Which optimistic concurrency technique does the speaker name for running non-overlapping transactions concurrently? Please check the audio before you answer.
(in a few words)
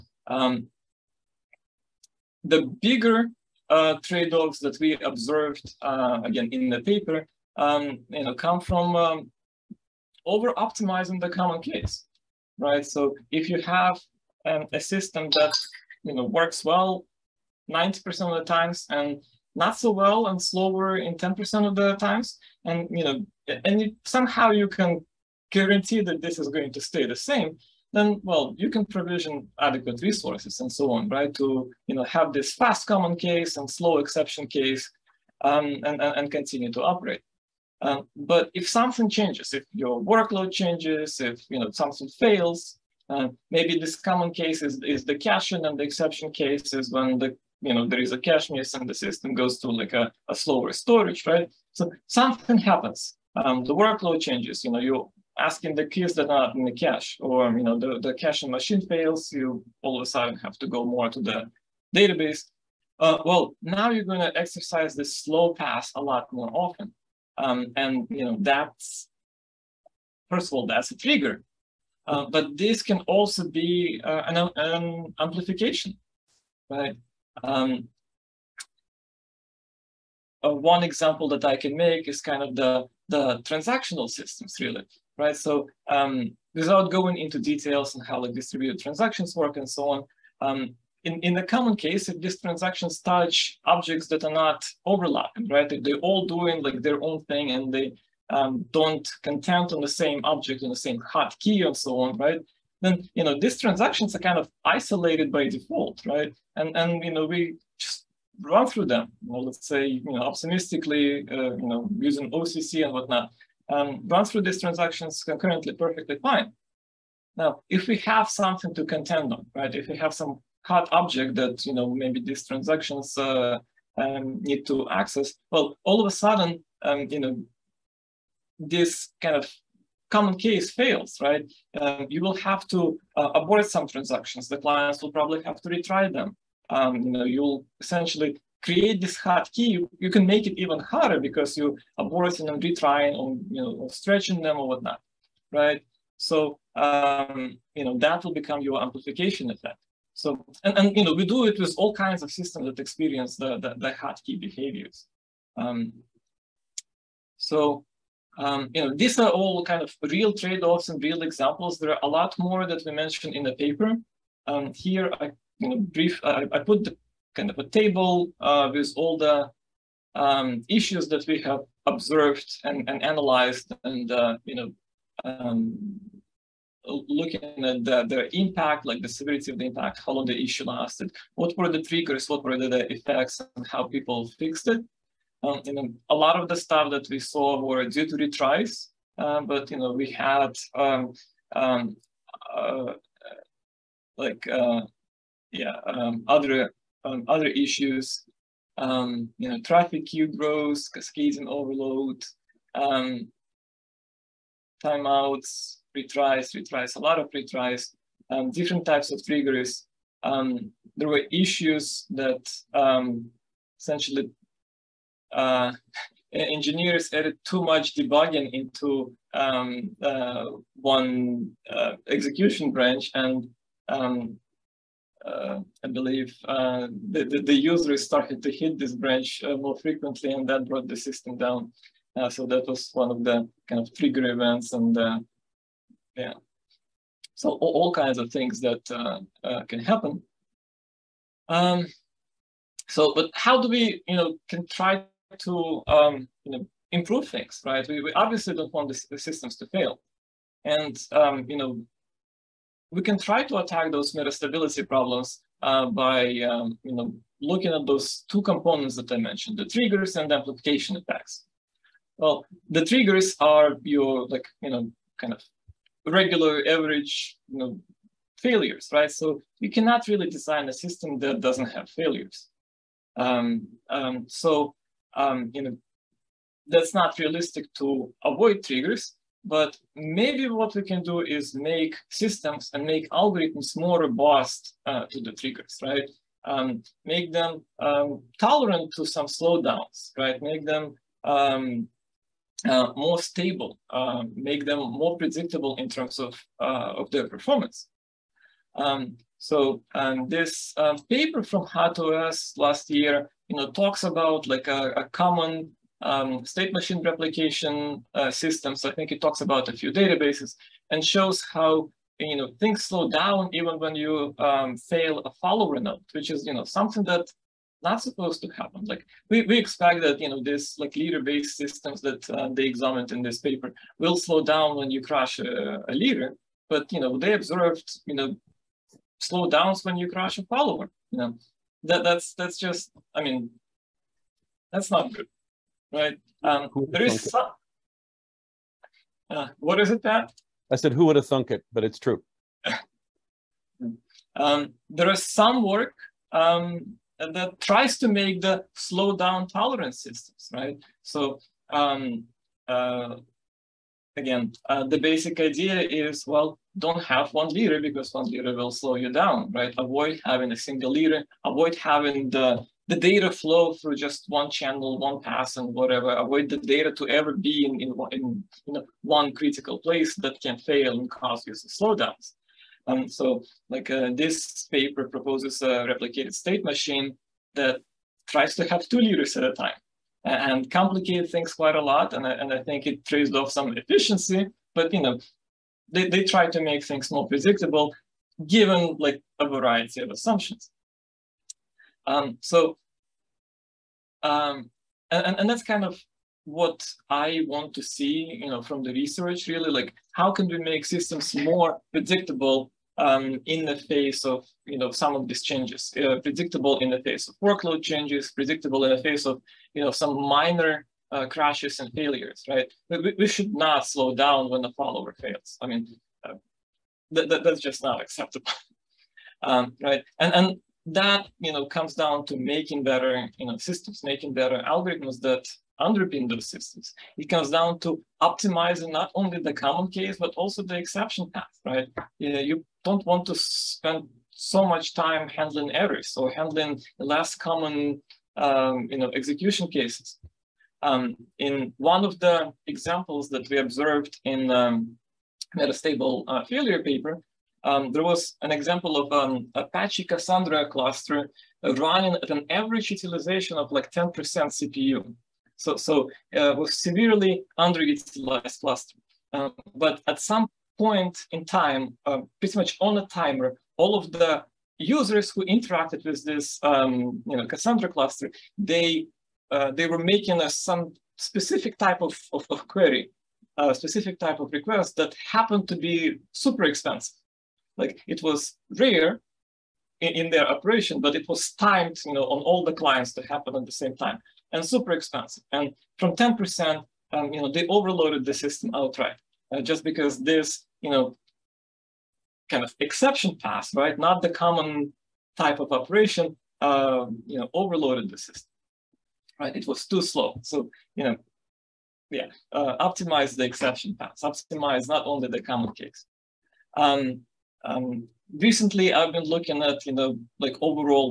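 OCC.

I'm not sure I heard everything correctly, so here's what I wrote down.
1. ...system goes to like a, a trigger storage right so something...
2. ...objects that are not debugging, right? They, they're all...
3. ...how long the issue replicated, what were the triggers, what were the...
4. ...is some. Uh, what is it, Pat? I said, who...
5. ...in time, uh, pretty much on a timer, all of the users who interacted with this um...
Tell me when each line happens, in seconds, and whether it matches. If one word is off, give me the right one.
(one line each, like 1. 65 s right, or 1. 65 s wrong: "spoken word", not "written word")
1. 48 s wrong: "slower", not "trigger"
2. 93 s wrong: "overlapping", not "debugging"
3. 180 s wrong: "lasted", not "replicated"
4. 337 s right
5. 461 s right.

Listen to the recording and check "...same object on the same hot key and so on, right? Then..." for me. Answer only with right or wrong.
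right.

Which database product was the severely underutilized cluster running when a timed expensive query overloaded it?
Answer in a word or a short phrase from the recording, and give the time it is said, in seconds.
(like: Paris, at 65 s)
Apache Cassandra, at 449 s.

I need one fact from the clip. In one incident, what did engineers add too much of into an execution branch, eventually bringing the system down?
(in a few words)
Debugging.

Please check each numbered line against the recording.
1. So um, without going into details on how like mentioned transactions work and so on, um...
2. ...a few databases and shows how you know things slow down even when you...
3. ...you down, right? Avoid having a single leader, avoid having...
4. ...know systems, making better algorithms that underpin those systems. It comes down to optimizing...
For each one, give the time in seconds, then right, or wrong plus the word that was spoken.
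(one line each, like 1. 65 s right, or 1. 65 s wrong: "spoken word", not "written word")
1. 85 s wrong: "distributed", not "mentioned"
2. 309 s right
3. 358 s right
4. 423 s right.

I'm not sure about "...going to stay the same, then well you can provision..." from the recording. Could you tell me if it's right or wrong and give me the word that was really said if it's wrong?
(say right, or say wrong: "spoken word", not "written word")
right.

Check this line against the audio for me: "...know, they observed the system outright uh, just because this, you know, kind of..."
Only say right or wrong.
wrong.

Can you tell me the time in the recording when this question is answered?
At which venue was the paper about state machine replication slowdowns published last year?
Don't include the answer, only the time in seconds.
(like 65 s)
301 s.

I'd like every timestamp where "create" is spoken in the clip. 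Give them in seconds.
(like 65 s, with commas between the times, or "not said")
138 s.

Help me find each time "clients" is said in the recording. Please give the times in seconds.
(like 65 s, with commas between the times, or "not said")
134 s, 482 s.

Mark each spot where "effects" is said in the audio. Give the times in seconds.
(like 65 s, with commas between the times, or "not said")
149 s, 182 s, 260 s.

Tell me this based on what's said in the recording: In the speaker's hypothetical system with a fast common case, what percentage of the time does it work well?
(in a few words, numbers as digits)
90%.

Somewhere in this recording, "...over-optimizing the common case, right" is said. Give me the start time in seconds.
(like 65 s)
10 s.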